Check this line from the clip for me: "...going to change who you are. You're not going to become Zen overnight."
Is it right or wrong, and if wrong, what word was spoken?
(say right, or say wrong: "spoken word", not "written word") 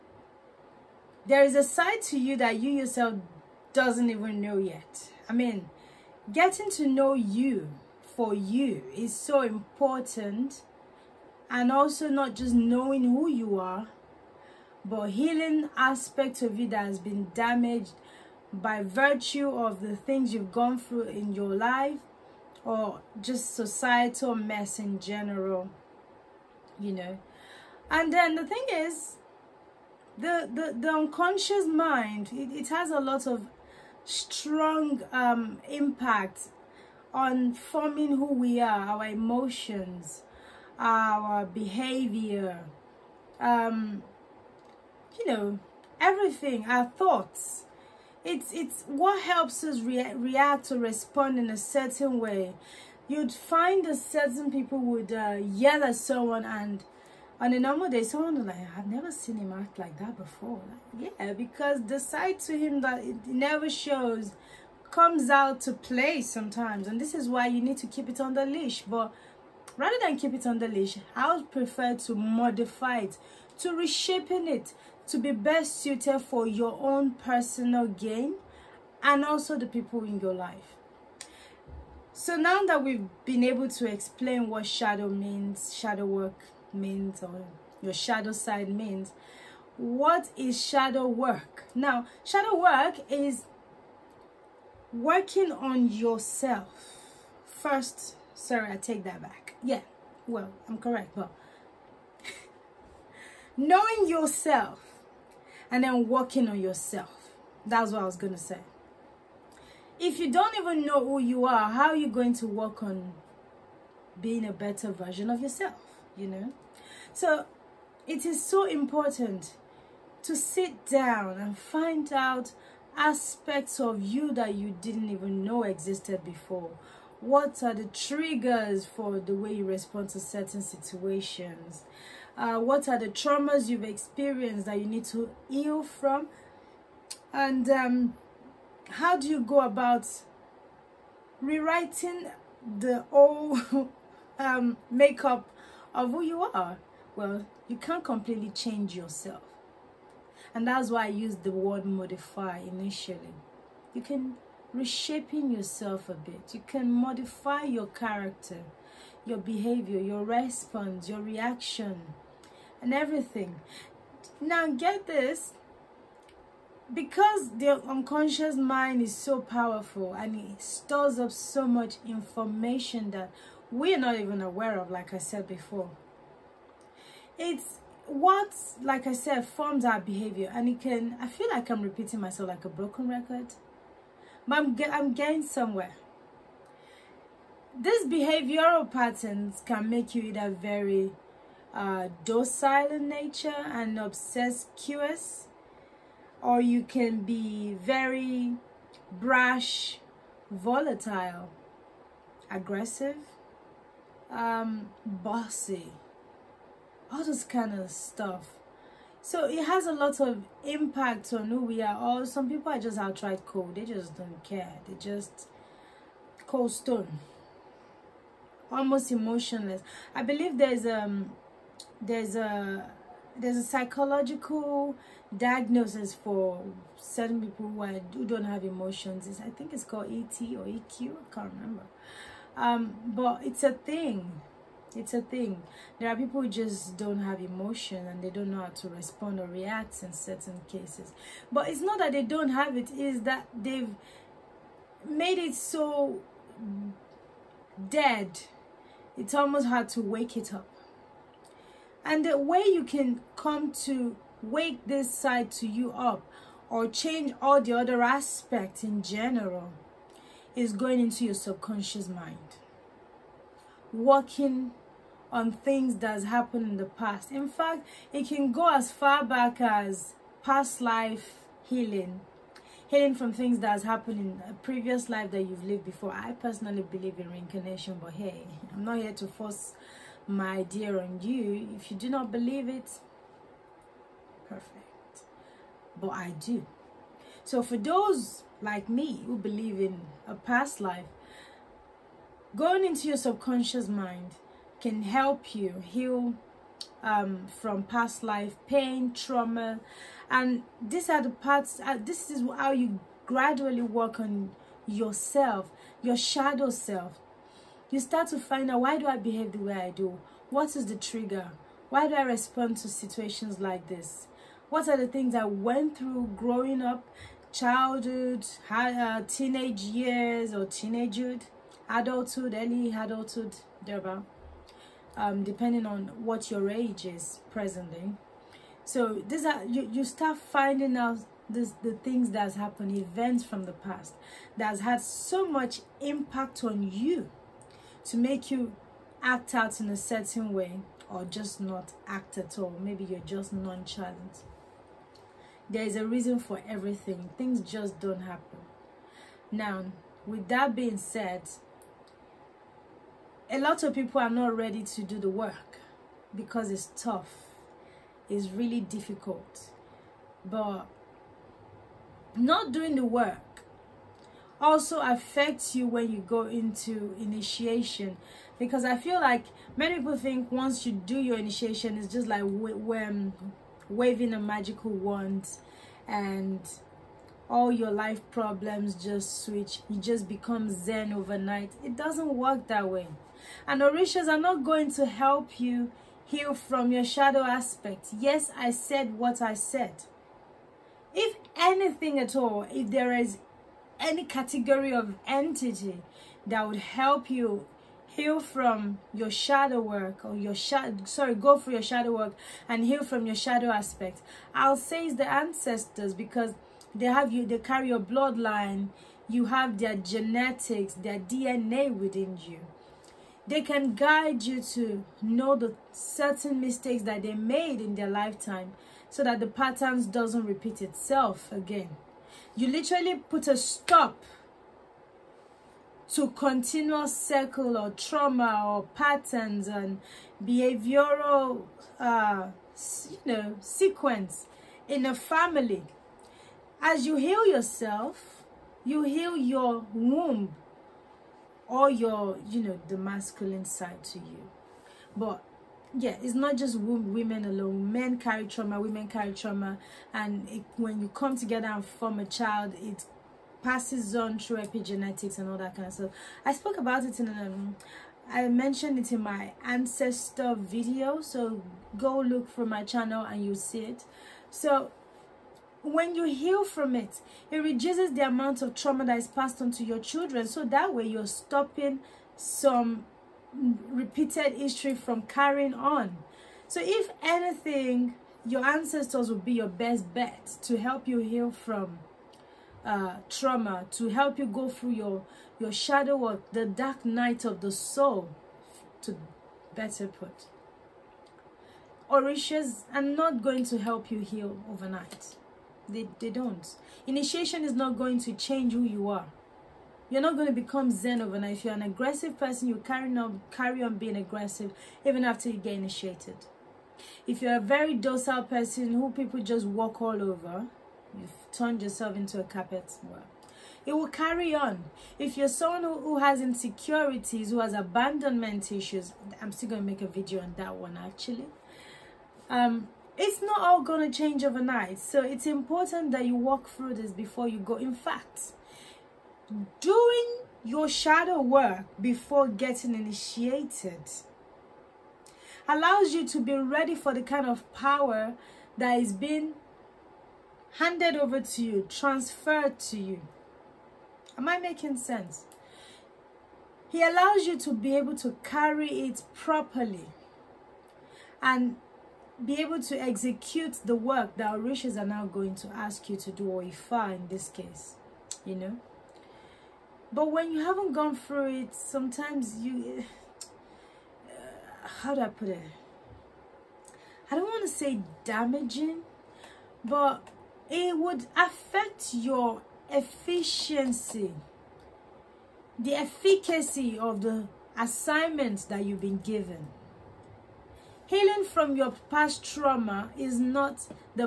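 right.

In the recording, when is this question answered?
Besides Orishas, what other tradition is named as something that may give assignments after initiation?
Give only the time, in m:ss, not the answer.
9:16.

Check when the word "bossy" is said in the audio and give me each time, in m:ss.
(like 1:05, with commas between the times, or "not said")
3:25.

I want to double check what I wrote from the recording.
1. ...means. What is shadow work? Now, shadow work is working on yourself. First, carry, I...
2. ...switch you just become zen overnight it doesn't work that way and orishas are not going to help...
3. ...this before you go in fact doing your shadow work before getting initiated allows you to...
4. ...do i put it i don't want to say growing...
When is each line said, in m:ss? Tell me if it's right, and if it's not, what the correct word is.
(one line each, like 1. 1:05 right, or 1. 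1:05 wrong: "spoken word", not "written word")
1. 1:28 wrong: "sorry", not "carry"
2. 6:19 right
3. 8:46 right
4. 9:25 wrong: "damaging", not "growing".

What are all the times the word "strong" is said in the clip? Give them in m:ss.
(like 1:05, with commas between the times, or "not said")
0:34.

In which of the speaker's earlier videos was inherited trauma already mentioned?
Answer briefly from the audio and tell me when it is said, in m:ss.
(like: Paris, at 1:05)
ancestor video, at 7:39.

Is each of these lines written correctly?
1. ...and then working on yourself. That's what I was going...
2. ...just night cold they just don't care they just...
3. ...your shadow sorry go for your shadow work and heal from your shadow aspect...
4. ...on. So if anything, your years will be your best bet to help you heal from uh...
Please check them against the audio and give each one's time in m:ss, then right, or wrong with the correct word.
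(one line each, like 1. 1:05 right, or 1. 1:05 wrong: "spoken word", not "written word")
1. 1:45 right
2. 3:32 wrong: "outright", not "night"
3. 6:40 right
4. 7:55 wrong: "ancestors", not "years".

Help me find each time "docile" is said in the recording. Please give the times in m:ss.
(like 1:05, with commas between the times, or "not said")
3:12, 8:27.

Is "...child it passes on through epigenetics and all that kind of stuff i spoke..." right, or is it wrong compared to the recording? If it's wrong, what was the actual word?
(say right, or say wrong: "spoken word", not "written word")
right.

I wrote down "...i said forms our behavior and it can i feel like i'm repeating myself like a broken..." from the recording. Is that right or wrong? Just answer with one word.
right.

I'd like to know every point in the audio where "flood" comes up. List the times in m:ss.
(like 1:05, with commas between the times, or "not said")
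not said.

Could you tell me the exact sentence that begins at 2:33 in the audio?
You can reshaping yourself a bit.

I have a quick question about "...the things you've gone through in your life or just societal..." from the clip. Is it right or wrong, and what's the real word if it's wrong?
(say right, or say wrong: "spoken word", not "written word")
right.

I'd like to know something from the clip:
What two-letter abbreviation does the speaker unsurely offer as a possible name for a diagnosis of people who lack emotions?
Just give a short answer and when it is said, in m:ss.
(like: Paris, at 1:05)
EQ, at 3:50.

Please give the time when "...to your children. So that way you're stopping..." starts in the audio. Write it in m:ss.
7:49.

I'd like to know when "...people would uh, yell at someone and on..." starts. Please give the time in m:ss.
0:54.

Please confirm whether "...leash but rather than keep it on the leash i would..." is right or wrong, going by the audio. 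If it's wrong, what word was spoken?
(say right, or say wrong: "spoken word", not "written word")
right.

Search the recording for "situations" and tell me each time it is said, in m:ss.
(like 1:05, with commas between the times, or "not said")
2:10, 5:12.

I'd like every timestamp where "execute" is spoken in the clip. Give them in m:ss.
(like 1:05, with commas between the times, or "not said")
9:13.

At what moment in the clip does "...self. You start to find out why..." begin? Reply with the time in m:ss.
5:06.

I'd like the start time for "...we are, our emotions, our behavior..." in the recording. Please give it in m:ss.
0:38.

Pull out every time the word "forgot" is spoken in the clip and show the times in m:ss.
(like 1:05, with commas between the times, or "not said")
not said.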